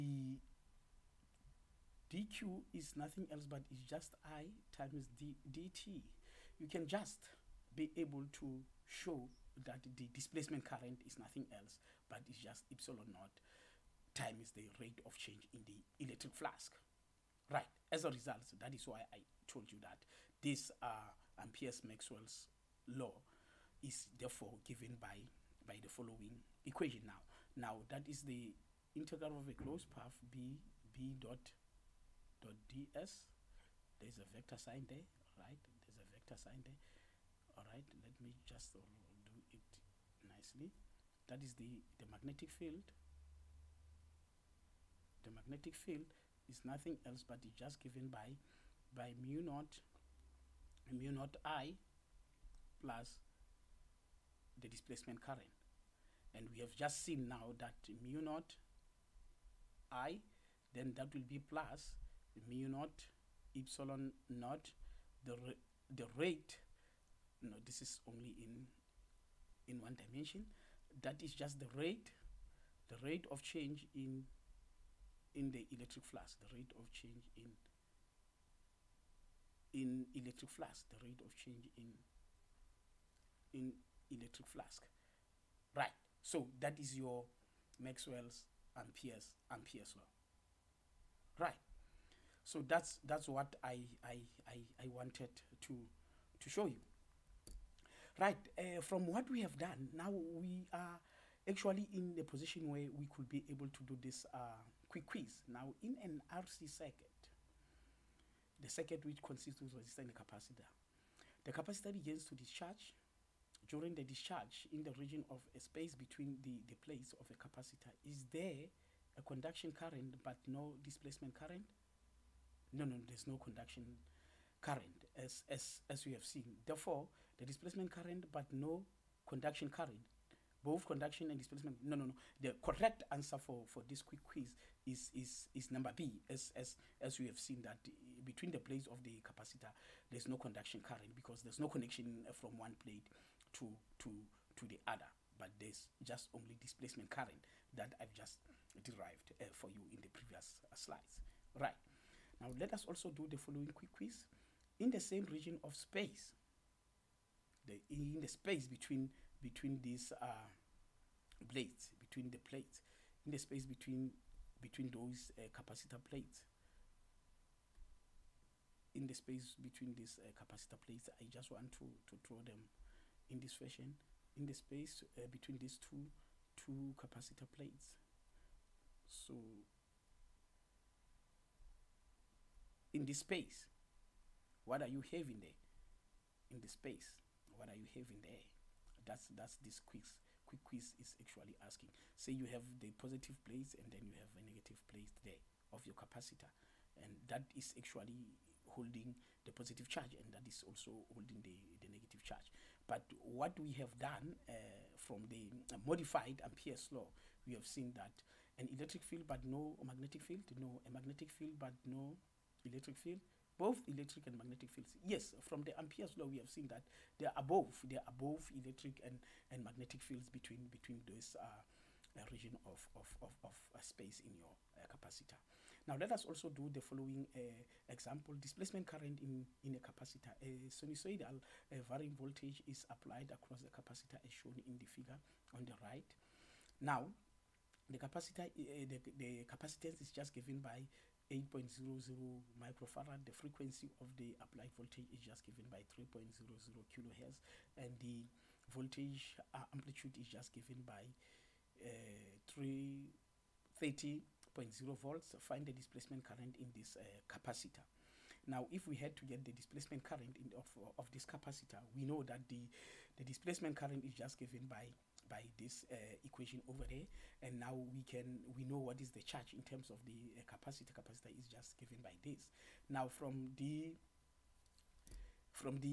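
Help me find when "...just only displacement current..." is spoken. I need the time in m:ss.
2:26.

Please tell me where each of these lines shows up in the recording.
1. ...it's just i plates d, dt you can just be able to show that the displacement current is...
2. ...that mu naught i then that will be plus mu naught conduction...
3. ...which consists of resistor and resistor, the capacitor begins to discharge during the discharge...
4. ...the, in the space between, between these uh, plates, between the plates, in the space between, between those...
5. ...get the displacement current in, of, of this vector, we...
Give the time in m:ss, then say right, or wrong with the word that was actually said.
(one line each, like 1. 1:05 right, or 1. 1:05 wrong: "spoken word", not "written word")
1. 0:03 wrong: "times", not "plates"
2. 0:57 wrong: "epsilon", not "conduction"
3. 1:49 wrong: "capacitor", not "resistor"
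4. 2:37 right
5. 4:19 wrong: "capacitor", not "vector".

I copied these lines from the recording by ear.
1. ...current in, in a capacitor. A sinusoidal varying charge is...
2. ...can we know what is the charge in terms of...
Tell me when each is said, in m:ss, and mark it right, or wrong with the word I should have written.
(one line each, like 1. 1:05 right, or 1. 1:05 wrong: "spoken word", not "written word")
1. 3:48 wrong: "voltage", not "charge"
2. 4:28 right.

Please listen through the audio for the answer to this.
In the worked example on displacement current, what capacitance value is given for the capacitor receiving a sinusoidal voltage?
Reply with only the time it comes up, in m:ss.
4:01.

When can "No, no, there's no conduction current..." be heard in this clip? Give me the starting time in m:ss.
2:02.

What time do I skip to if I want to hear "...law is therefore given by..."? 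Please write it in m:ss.
0:22.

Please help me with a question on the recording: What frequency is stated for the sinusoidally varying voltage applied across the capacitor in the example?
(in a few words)
3.00 kilohertz.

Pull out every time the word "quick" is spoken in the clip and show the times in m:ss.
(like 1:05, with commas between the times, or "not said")
1:44, 2:14, 2:33, 3:10.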